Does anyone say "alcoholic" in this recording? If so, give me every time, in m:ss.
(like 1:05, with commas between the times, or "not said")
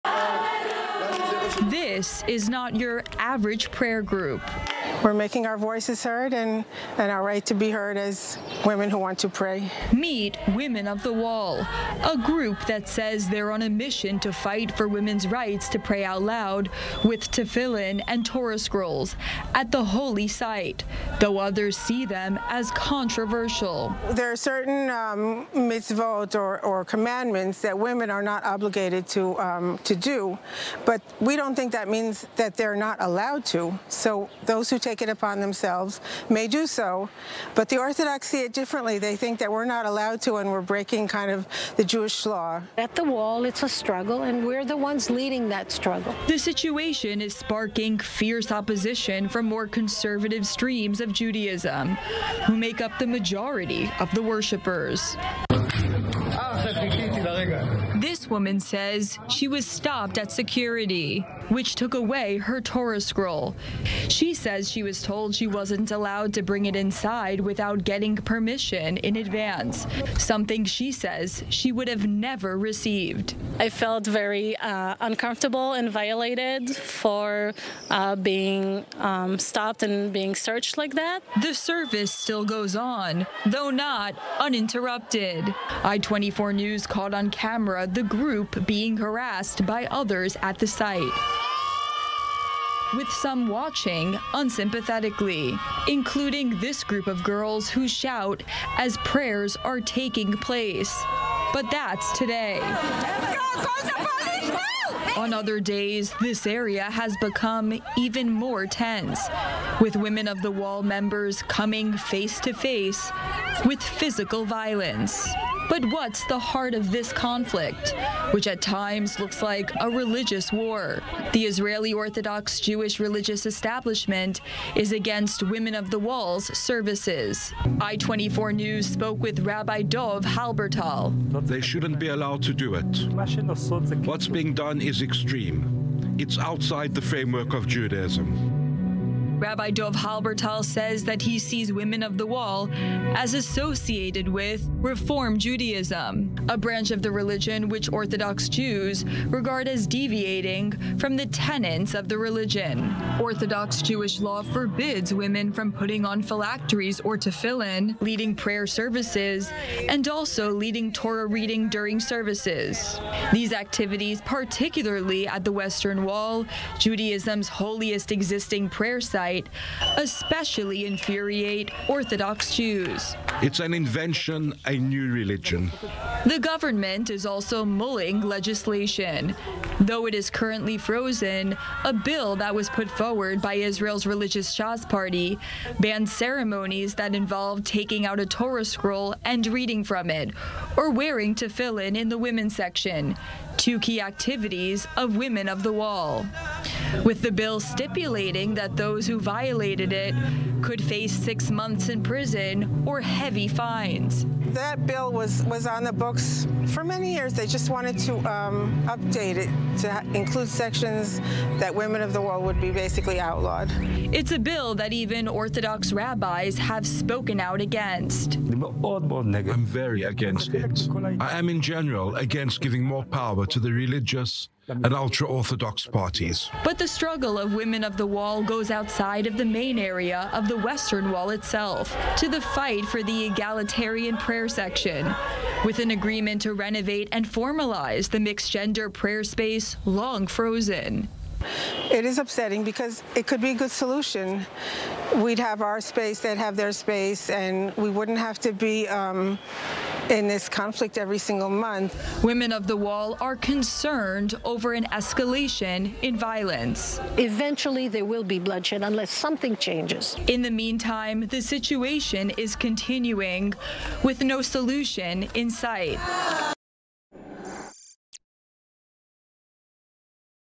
not said.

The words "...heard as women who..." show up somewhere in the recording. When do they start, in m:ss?
0:07.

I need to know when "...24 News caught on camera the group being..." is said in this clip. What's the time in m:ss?
1:25.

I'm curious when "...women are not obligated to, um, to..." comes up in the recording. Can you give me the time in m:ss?
0:27.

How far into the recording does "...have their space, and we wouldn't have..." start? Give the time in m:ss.
4:06.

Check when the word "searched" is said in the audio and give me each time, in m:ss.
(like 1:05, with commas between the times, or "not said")
1:20.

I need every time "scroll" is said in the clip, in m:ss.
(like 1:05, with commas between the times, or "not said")
0:18, 1:03, 3:08.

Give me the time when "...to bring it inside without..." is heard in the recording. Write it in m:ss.
1:06.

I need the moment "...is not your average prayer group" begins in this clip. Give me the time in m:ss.
0:02.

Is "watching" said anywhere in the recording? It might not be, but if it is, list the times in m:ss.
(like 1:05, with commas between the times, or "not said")
1:33.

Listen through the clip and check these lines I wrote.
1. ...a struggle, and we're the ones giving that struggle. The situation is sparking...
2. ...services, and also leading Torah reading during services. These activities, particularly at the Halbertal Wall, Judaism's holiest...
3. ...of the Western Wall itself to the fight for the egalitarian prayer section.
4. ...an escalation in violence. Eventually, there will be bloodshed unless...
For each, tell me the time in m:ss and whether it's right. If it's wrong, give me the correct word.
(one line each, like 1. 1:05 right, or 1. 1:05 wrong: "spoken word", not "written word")
1. 0:43 wrong: "leading", not "giving"
2. 2:38 wrong: "Western", not "Halbertal"
3. 3:50 right
4. 4:14 right.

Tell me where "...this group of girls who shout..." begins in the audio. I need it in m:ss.
1:36.